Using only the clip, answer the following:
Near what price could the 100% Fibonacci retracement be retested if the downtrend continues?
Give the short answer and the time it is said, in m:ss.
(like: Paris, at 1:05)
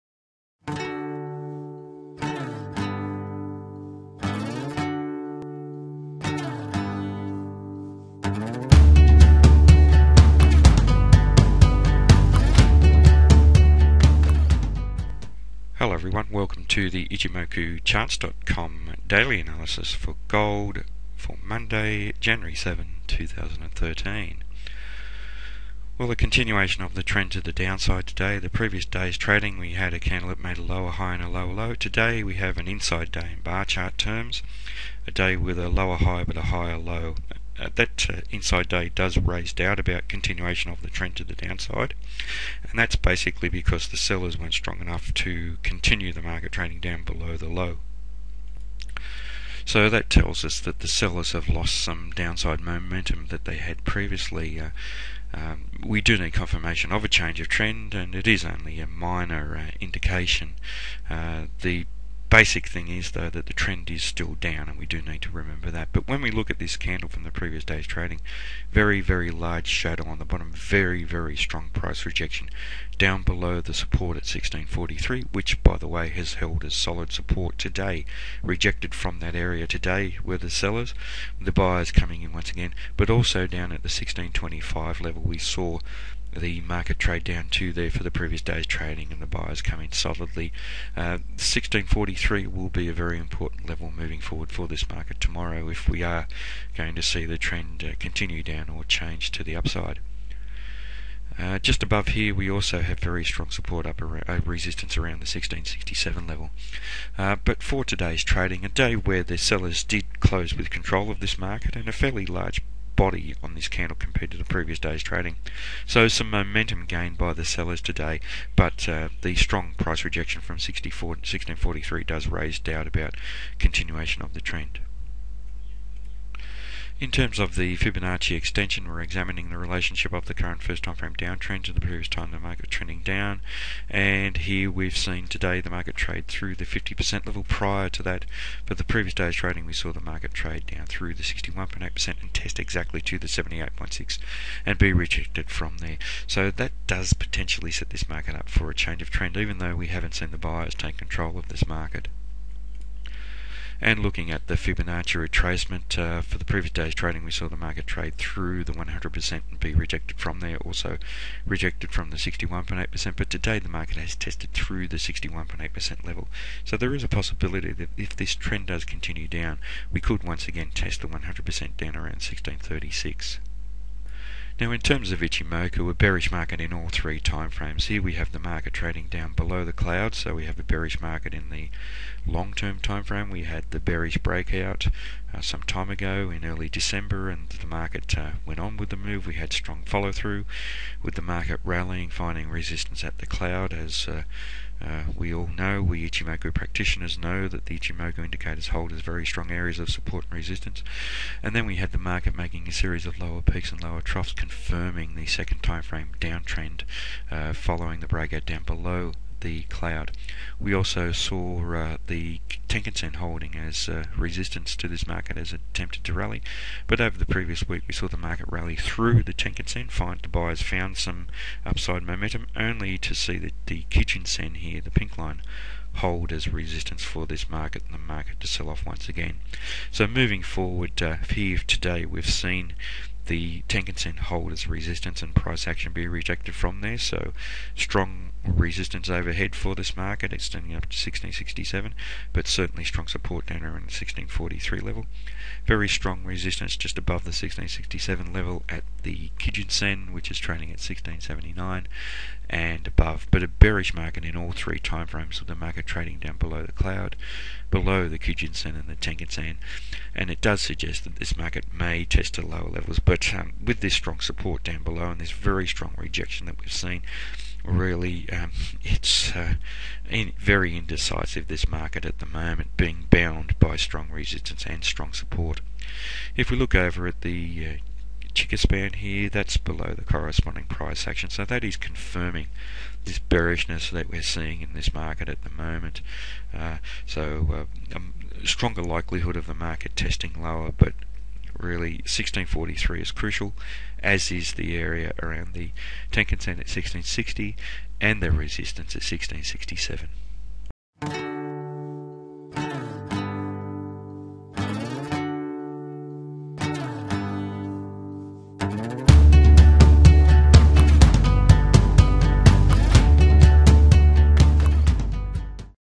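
1636, at 2:52.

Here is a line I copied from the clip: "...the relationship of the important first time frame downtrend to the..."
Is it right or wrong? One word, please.
wrong.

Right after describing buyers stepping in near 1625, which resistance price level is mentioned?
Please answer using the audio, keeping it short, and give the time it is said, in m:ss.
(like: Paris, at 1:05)
1667, at 1:44.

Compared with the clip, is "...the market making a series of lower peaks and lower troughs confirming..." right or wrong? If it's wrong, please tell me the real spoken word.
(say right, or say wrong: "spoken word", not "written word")
right.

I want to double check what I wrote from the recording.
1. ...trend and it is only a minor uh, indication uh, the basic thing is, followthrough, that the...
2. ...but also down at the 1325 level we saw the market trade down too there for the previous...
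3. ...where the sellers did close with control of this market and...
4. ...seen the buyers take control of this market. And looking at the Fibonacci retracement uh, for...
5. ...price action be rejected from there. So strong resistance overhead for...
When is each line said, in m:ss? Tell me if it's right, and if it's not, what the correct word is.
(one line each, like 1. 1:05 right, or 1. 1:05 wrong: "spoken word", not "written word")
1. 0:57 wrong: "though", not "followthrough"
2. 1:22 wrong: "1625", not "1325"
3. 1:48 right
4. 2:30 right
5. 3:55 right.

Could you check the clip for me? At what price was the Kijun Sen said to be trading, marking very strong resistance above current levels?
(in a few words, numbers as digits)
1679.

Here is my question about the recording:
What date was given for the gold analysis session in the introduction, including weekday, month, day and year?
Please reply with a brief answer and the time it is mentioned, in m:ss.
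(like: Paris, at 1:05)
Monday, January 7, 2013, at 0:21.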